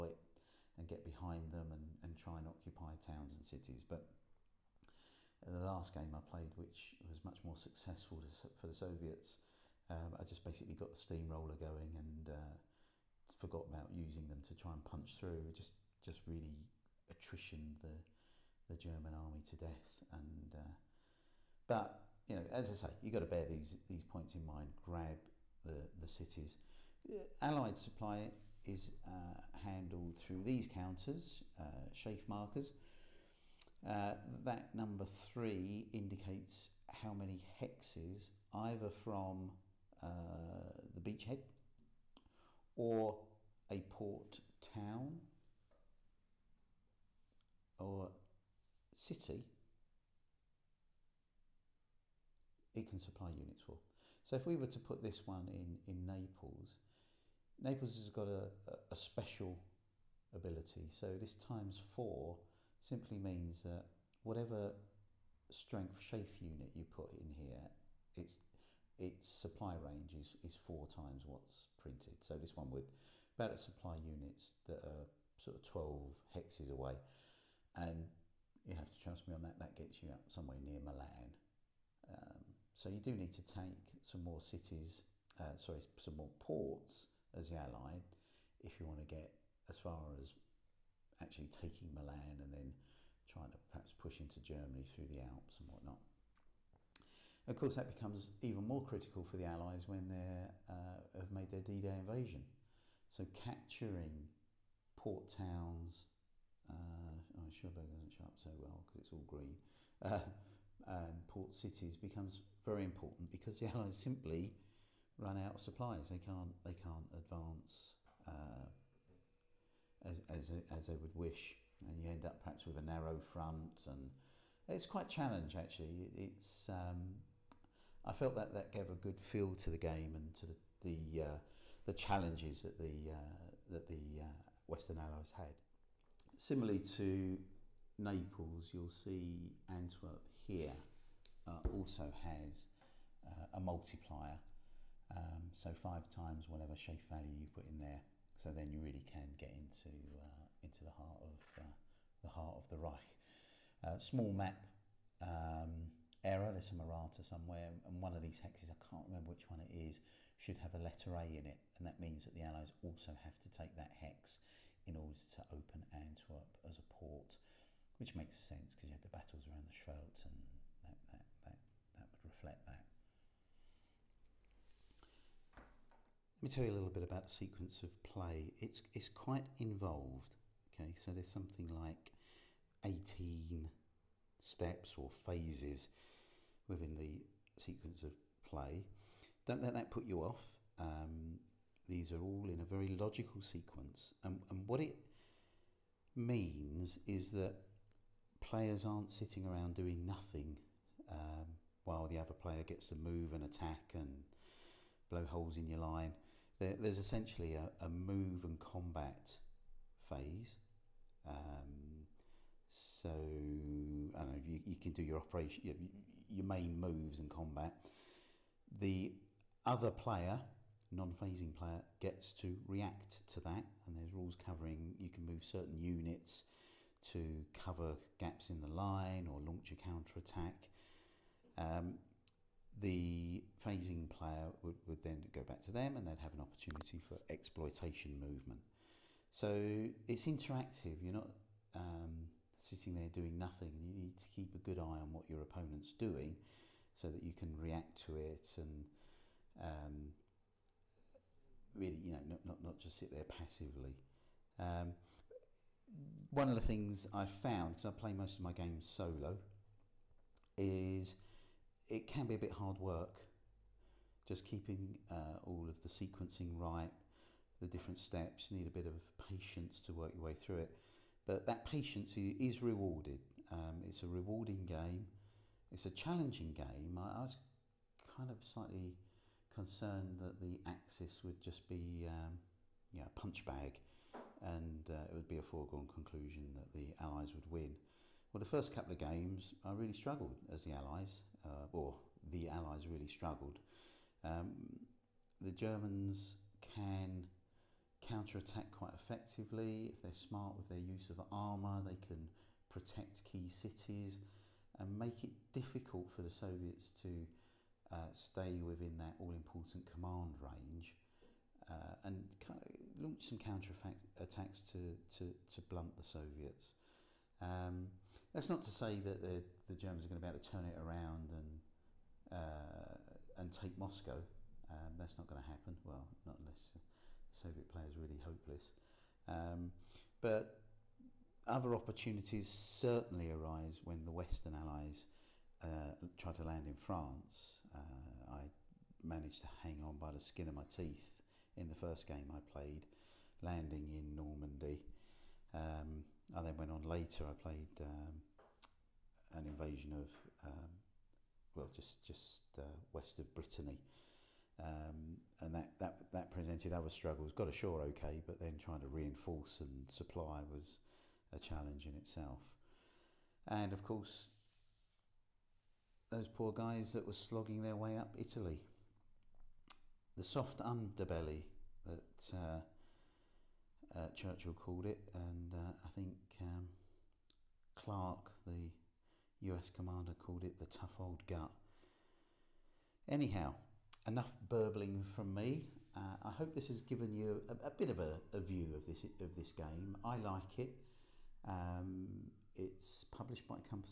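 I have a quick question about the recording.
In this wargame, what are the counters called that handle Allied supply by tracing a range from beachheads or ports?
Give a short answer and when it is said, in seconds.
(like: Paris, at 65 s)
SHAEF markers, at 31 s.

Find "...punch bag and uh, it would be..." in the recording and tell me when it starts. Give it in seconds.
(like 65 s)
283 s.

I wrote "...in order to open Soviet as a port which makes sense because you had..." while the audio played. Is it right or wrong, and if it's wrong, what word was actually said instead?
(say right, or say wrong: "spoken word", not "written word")
wrong: "Antwerp", not "Soviet".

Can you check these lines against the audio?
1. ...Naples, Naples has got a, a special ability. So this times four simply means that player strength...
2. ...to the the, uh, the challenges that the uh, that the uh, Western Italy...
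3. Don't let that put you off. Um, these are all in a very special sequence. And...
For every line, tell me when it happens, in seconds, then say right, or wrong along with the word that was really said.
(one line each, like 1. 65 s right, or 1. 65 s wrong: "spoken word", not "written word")
1. 56 s wrong: "whatever", not "player"
2. 130 s wrong: "Allies", not "Italy"
3. 189 s wrong: "logical", not "special".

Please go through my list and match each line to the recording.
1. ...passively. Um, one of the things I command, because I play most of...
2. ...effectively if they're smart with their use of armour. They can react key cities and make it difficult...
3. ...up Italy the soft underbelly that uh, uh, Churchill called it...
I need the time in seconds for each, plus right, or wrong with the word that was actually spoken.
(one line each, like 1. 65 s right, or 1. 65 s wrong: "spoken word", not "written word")
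1. 253 s wrong: "found", not "command"
2. 298 s wrong: "protect", not "react"
3. 367 s right.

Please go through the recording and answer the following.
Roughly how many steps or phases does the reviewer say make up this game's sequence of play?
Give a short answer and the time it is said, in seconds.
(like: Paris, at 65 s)
18, at 182 s.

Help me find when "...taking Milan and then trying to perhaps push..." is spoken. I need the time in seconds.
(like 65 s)
91 s.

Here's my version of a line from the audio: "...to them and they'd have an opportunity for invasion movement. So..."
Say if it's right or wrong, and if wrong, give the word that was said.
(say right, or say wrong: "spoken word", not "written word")
wrong: "exploitation", not "invasion".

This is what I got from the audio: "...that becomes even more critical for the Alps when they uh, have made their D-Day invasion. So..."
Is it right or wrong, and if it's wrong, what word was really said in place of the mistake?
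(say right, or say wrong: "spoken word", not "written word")
wrong: "Allies", not "Alps".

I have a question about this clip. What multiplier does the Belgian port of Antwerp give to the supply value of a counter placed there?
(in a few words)
5.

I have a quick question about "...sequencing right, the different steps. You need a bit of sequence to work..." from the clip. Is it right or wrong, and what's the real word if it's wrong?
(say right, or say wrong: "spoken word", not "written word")
wrong: "patience", not "sequence".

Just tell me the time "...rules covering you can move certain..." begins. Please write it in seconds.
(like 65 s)
224 s.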